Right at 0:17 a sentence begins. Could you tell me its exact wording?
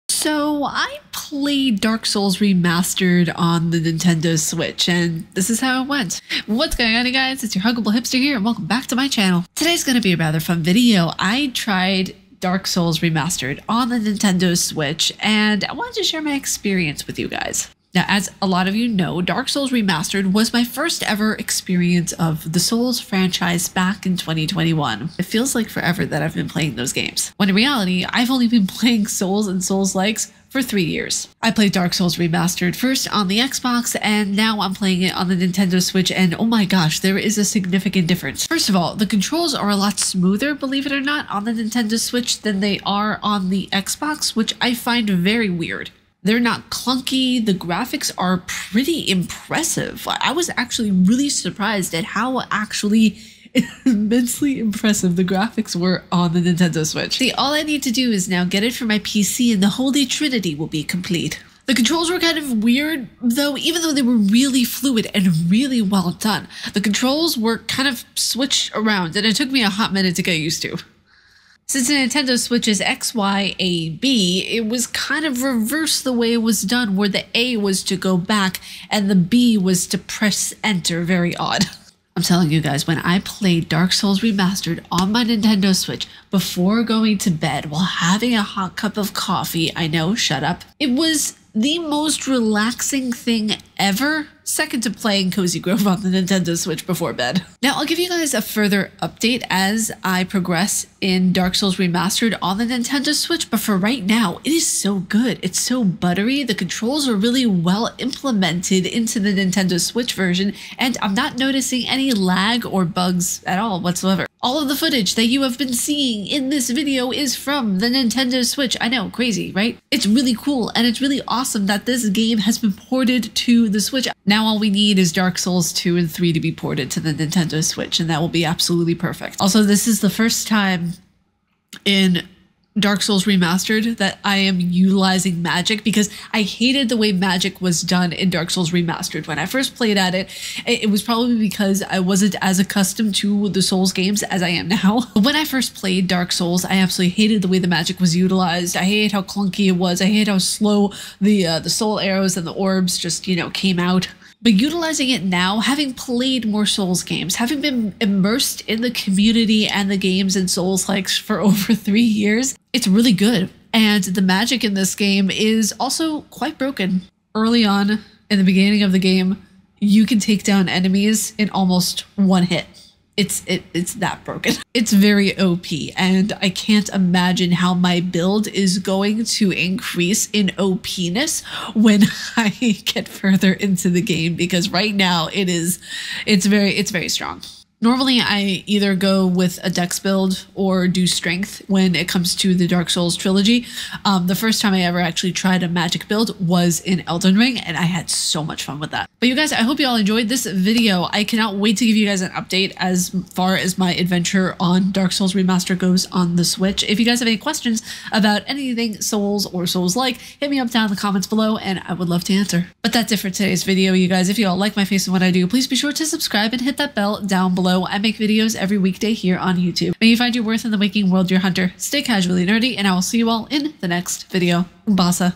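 Now, as a lot of you know, Dark Souls Remastered was my first ever experience of the Souls franchise back in 2021.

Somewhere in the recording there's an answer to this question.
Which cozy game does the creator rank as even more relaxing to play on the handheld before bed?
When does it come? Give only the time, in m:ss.
1:35.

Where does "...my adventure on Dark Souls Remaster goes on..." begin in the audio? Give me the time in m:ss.
3:23.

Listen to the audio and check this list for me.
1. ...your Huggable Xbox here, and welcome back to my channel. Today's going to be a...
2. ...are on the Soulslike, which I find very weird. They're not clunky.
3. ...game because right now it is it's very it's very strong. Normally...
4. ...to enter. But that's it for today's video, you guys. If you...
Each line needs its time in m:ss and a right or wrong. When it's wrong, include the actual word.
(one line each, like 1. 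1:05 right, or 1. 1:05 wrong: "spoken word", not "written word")
1. 0:07 wrong: "Hipster", not "Xbox"
2. 0:42 wrong: "Xbox", not "Soulslike"
3. 3:04 right
4. 3:32 wrong: "answer", not "enter".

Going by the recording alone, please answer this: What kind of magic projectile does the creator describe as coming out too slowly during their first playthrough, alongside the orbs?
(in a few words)
soul arrows.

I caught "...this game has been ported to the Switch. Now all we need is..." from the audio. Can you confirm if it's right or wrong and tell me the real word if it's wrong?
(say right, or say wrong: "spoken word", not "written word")
right.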